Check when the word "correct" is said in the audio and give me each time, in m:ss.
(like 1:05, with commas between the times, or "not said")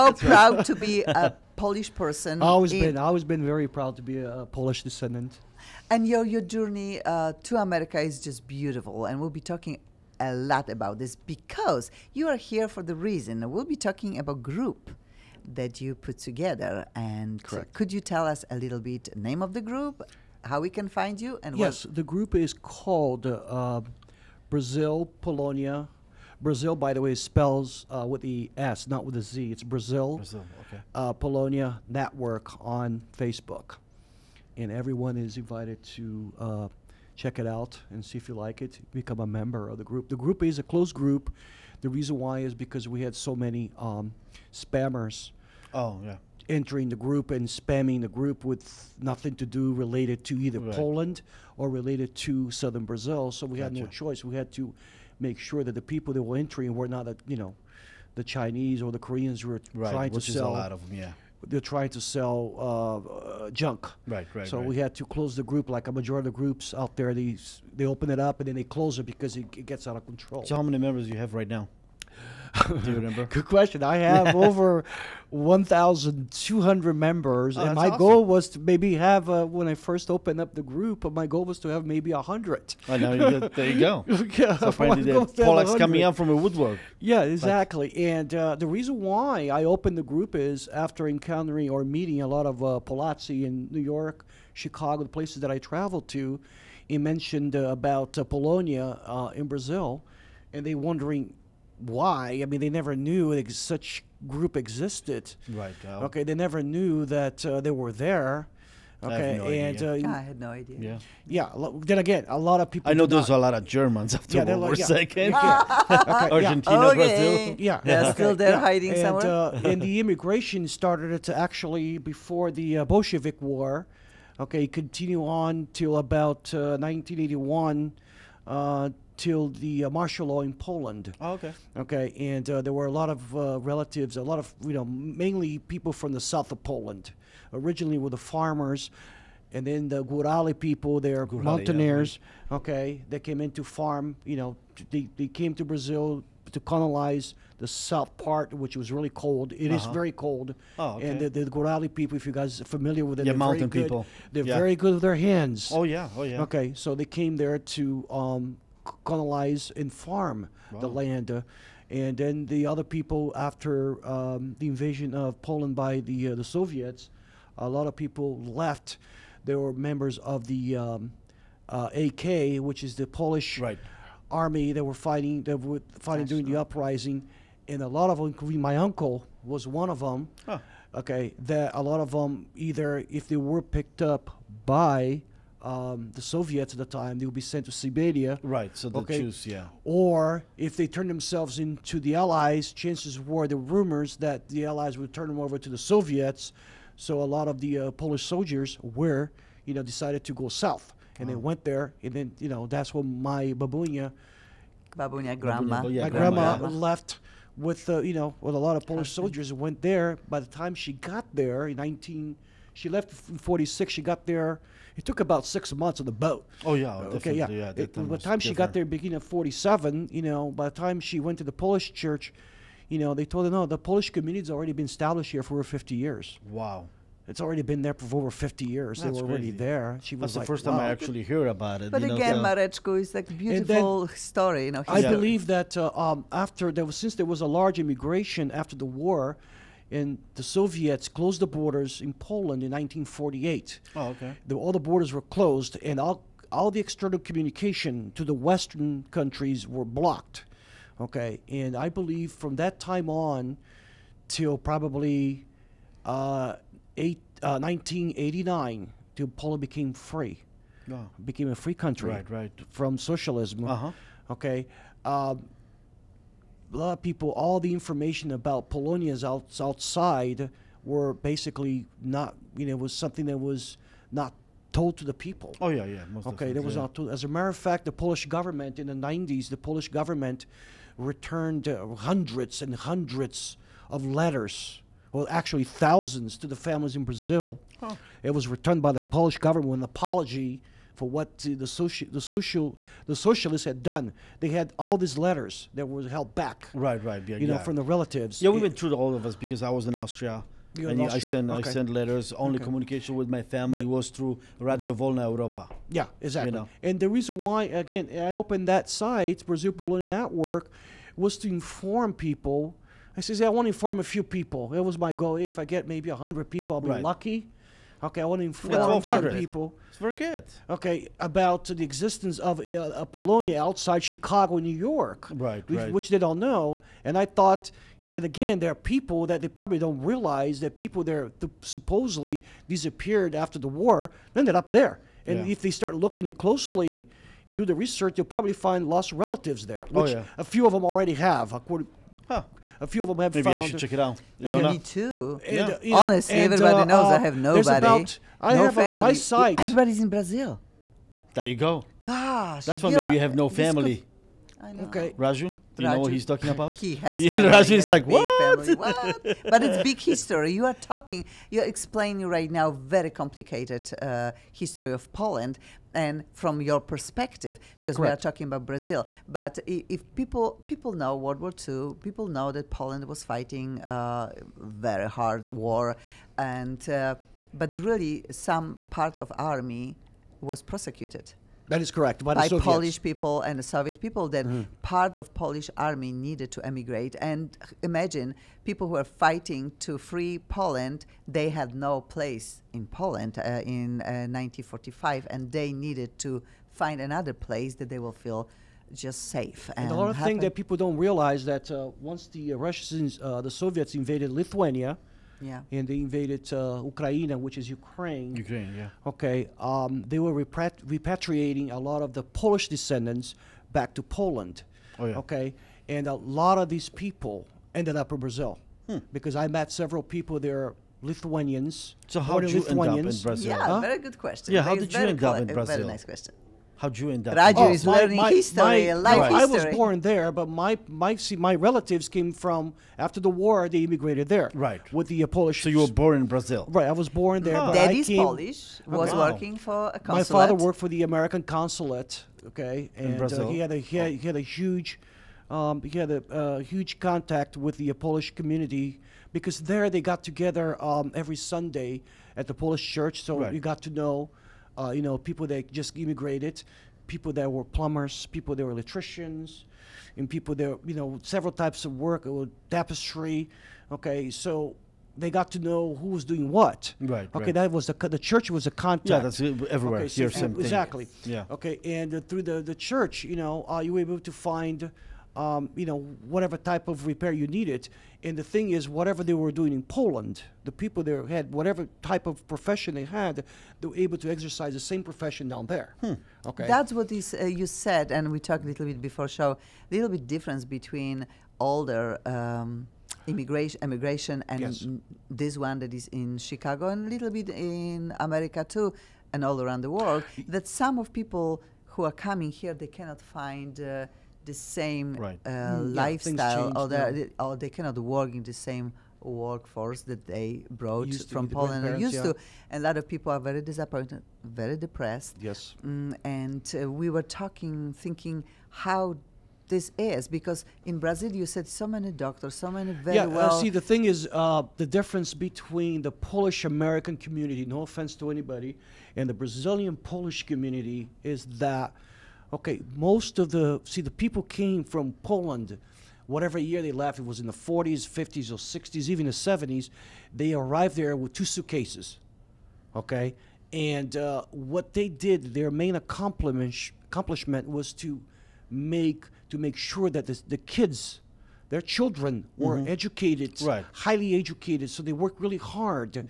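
0:17, 6:07, 6:21.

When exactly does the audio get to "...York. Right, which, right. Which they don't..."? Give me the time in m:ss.
5:24.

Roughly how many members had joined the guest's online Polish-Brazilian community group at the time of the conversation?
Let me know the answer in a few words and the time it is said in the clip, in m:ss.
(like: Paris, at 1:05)
over 1,200, at 1:14.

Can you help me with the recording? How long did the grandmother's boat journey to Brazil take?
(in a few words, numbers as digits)
6 months.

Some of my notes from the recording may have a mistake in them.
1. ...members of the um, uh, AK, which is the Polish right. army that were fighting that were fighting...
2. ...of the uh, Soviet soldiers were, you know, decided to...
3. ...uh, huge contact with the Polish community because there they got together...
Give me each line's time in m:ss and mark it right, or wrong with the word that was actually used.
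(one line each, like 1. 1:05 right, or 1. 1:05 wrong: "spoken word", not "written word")
1. 2:49 right
2. 3:17 wrong: "Polish", not "Soviet"
3. 7:26 right.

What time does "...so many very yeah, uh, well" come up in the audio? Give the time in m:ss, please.
8:42.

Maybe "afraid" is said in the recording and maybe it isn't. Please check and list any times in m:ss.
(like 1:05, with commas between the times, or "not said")
not said.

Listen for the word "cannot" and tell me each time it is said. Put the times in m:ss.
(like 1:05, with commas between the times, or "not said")
8:22, 8:27.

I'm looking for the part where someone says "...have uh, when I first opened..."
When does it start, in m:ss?
1:18.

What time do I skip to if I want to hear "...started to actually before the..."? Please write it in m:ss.
2:00.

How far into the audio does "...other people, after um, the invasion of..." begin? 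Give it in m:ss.
2:42.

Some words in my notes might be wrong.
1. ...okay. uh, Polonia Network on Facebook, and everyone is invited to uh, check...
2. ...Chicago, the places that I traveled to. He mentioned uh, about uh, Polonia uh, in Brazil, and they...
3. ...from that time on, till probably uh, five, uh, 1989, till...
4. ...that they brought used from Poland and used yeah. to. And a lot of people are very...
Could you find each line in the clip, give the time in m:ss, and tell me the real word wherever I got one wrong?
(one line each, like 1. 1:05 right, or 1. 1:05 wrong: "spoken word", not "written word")
1. 0:30 right
2. 1:34 right
3. 4:12 wrong: "eight", not "five"
4. 8:30 right.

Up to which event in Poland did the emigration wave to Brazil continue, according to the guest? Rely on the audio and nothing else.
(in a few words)
martial law.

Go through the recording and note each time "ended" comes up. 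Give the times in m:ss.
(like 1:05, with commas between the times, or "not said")
5:34, 6:57.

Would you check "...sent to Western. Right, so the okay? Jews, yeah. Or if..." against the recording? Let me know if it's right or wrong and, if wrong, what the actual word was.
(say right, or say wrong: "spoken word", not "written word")
wrong: "Siberia", not "Western".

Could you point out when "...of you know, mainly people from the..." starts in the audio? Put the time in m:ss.
2:14.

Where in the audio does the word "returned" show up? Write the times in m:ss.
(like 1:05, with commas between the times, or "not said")
4:40, 4:48.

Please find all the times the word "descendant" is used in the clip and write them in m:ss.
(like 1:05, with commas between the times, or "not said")
0:04, 6:52.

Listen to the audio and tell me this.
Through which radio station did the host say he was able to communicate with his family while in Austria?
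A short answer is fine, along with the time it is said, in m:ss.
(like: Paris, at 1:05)
Radio Wolna Europa, at 5:04.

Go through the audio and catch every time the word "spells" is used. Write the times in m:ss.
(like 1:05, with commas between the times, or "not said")
0:27.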